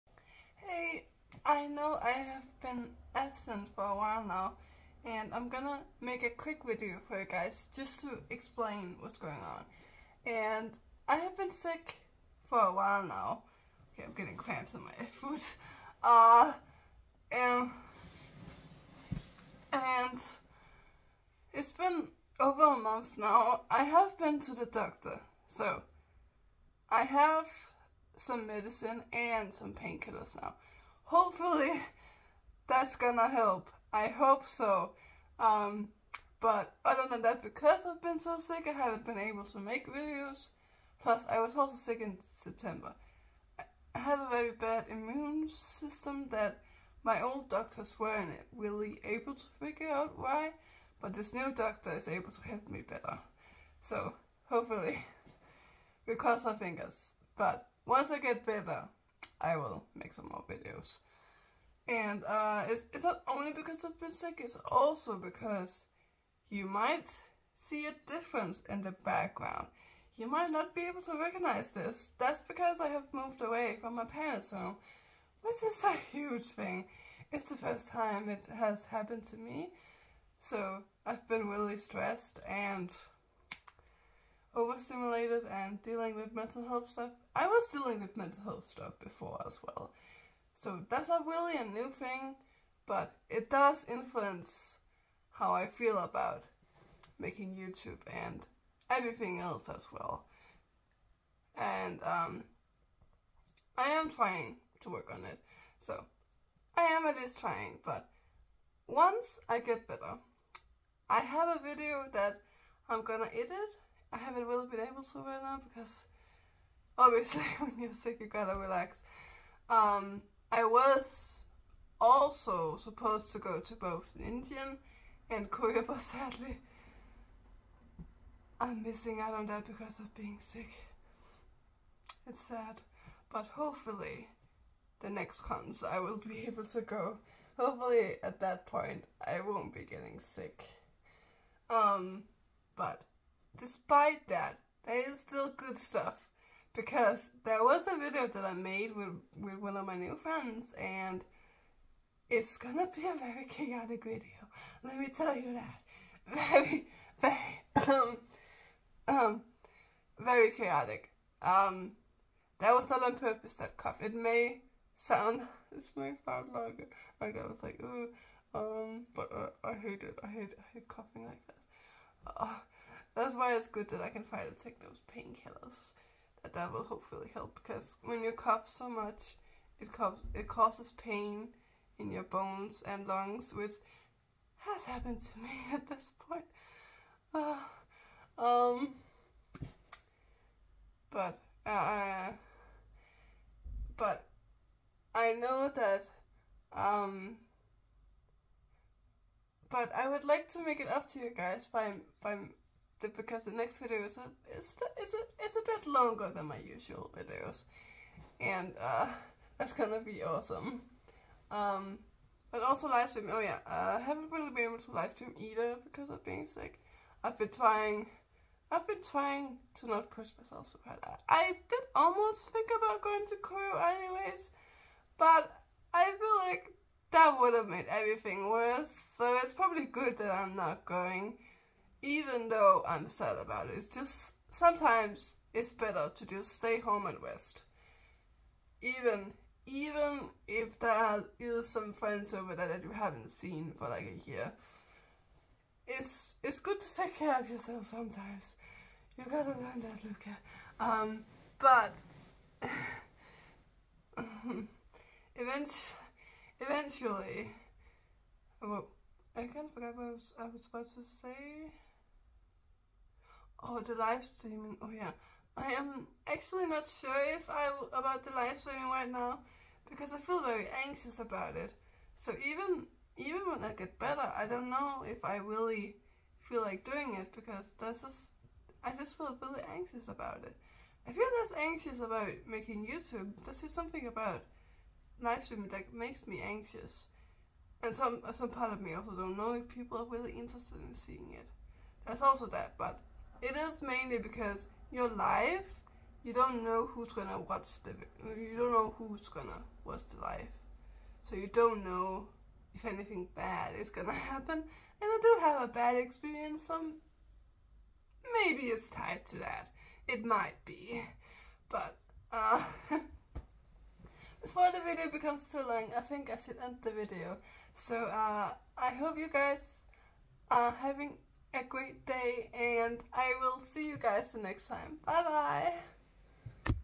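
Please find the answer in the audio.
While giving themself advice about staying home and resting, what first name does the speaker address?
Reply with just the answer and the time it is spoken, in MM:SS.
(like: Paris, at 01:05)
Luca, at 04:10.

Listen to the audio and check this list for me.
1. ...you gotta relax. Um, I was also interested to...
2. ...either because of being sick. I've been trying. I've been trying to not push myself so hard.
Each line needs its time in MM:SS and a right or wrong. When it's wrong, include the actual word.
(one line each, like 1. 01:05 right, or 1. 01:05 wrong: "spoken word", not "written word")
1. 01:58 wrong: "supposed", not "interested"
2. 03:35 right.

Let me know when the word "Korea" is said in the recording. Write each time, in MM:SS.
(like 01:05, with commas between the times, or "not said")
02:05, 03:43.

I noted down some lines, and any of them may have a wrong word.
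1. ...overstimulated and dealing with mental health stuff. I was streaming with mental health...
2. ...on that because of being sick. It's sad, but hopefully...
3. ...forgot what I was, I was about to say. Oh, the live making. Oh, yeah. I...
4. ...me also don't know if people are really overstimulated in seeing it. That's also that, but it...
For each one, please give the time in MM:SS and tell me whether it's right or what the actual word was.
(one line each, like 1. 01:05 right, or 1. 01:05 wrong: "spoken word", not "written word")
1. 01:24 wrong: "dealing", not "streaming"
2. 02:09 right
3. 04:19 wrong: "streaming", not "making"
4. 04:48 wrong: "interested", not "overstimulated".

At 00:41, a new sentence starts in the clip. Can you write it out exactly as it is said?
Plus, I was also sick in September.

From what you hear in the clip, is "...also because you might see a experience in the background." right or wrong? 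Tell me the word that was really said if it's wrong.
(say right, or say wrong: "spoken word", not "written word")
wrong: "difference", not "experience".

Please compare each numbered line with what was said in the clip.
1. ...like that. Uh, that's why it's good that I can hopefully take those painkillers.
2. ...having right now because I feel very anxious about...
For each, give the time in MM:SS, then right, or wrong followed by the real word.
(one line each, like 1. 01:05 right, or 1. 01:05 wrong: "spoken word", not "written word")
1. 02:51 wrong: "finally", not "hopefully"
2. 04:28 wrong: "streaming", not "having".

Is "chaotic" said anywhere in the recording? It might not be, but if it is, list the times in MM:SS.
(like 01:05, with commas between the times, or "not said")
02:33, 02:40.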